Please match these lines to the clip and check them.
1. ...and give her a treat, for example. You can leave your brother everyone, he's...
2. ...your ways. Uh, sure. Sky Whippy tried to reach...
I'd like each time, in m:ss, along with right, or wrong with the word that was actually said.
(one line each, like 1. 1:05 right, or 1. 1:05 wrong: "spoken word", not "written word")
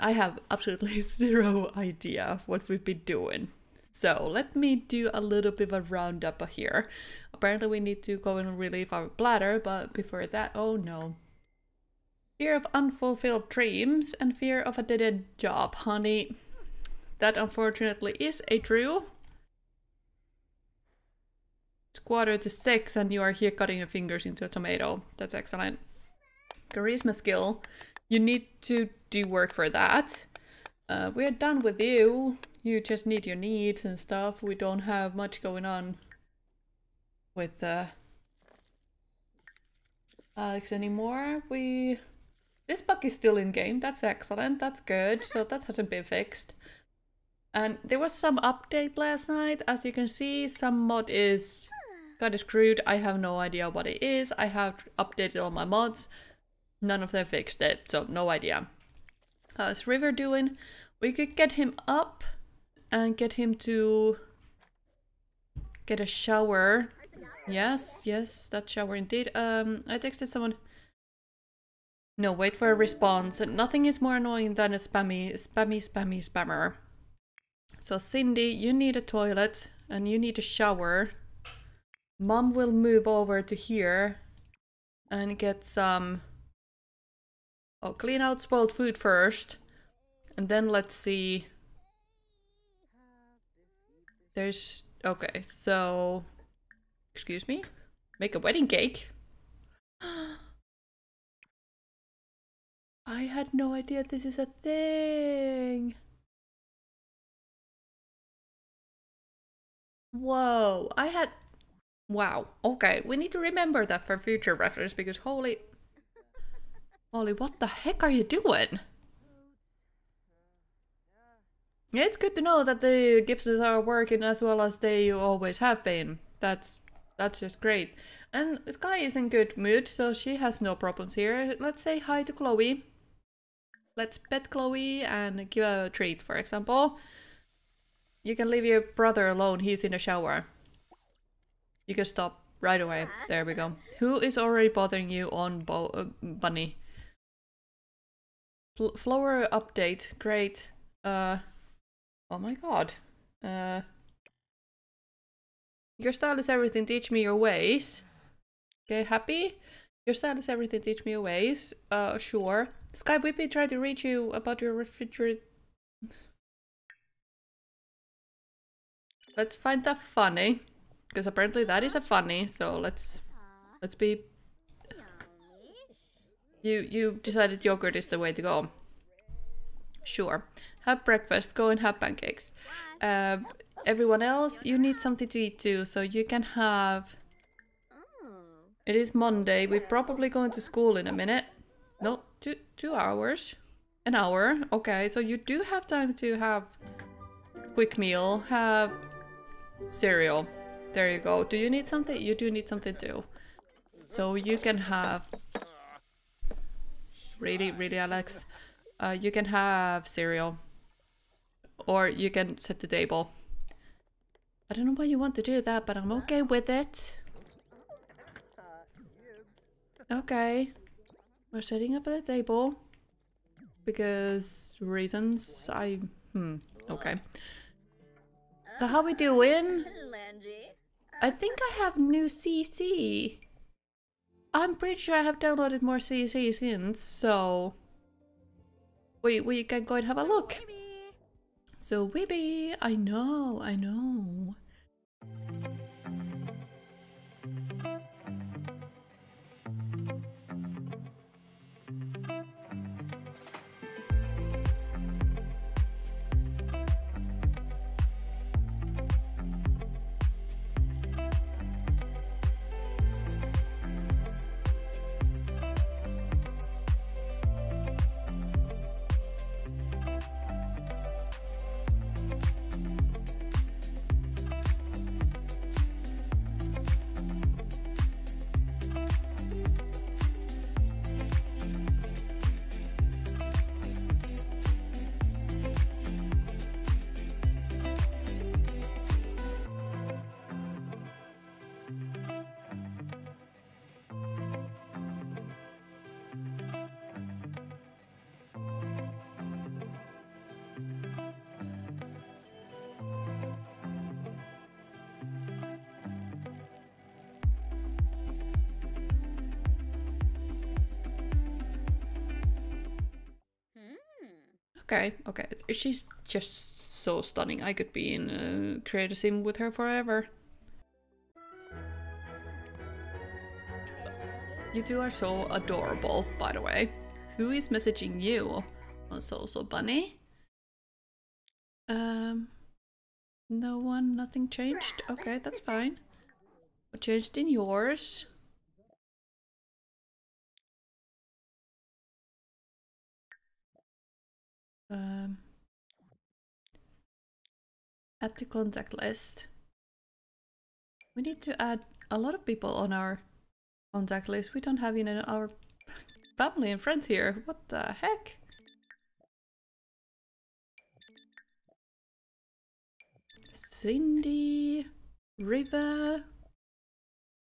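1. 2:15 wrong: "alone", not "everyone"
2. 2:41 right.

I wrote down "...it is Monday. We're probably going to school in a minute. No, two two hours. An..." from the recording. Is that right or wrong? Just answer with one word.
right.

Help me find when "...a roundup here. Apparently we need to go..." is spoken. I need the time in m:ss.
0:05.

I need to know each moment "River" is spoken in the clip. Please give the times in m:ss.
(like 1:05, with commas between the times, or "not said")
0:59, 6:05.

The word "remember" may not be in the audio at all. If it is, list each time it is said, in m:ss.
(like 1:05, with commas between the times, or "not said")
1:53.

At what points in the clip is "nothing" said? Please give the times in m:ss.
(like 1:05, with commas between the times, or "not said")
1:13, 5:34.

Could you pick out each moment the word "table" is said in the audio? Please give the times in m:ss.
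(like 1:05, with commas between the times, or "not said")
3:32, 3:42.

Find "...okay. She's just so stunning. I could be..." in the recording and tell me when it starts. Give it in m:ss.
5:15.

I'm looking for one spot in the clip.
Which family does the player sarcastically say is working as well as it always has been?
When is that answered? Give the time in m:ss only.
2:03.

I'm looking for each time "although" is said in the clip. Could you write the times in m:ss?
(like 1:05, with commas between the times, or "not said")
not said.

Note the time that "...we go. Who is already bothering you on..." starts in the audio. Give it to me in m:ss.
2:23.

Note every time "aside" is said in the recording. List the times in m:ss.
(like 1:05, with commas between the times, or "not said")
not said.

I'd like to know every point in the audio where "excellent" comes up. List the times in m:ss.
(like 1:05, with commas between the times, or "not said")
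0:25, 0:44.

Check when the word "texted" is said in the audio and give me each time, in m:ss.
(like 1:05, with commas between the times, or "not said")
1:09.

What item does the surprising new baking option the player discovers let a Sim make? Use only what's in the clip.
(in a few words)
Wedding cake.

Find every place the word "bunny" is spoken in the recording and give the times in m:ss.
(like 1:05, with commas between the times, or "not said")
2:26, 5:29.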